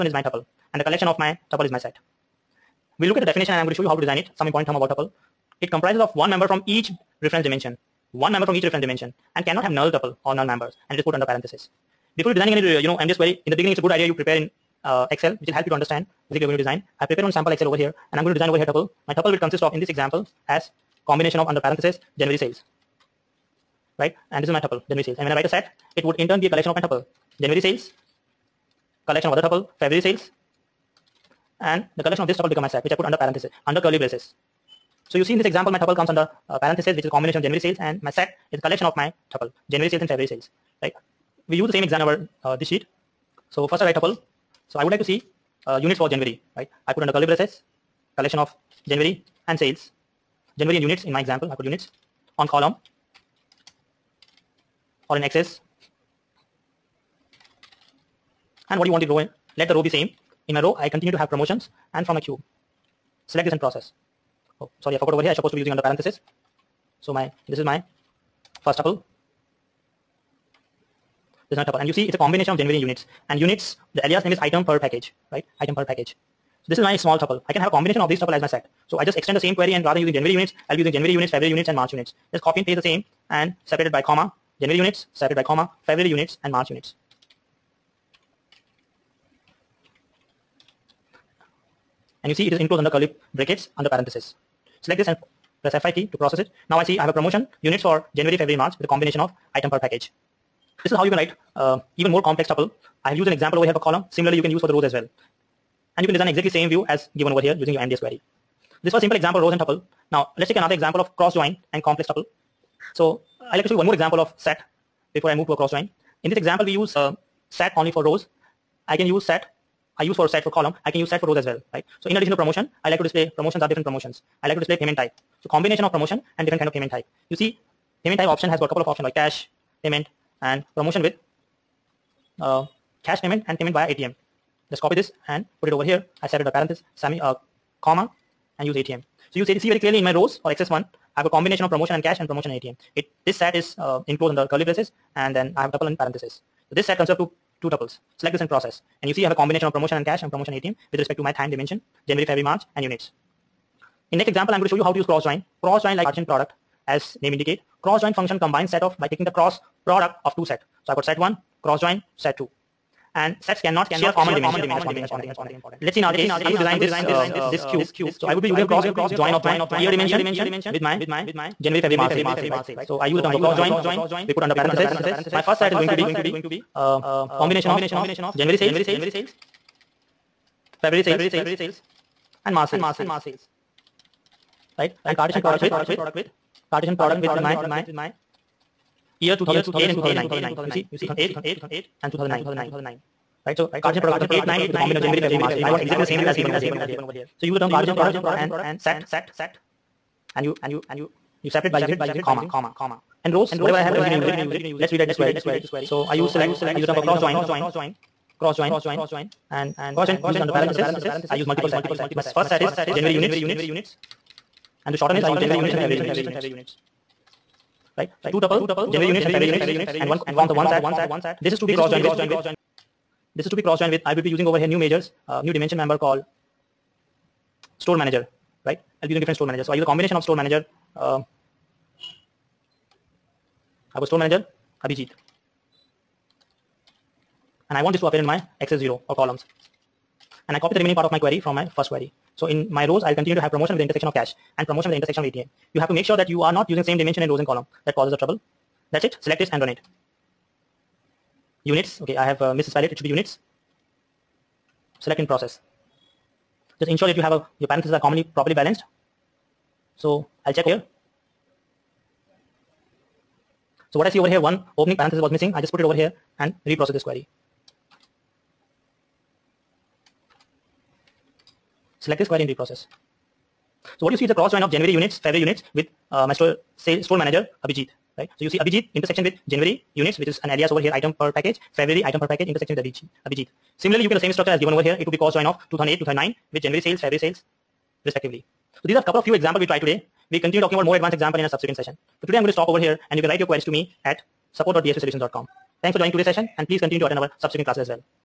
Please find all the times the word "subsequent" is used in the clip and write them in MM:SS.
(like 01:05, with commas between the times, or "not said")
04:51, 04:57.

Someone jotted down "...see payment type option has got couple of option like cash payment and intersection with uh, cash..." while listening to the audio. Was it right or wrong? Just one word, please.
wrong.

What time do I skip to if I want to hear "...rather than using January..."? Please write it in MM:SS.
01:19.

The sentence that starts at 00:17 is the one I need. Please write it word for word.
I prepare one sample Excel over here and I'm going to design over here tuple.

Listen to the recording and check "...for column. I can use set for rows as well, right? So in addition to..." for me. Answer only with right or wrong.
right.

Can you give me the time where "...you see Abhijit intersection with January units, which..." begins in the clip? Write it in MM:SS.
04:38.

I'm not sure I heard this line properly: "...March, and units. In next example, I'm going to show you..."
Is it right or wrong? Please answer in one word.
right.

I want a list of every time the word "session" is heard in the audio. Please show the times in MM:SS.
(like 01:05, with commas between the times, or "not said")
04:51, 04:56.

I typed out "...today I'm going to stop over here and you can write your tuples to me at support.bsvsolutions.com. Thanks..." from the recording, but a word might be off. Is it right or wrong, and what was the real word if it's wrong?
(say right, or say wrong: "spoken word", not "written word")
wrong: "queries", not "tuples".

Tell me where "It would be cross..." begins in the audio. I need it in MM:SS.
04:44.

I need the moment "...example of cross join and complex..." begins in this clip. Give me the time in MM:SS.
01:50.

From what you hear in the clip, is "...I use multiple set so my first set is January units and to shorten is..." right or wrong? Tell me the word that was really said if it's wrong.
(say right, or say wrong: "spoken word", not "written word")
right.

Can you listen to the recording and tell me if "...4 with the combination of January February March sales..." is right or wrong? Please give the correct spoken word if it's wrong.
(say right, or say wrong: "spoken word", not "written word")
wrong: "9", not "4".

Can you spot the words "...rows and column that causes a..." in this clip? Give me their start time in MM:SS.
04:07.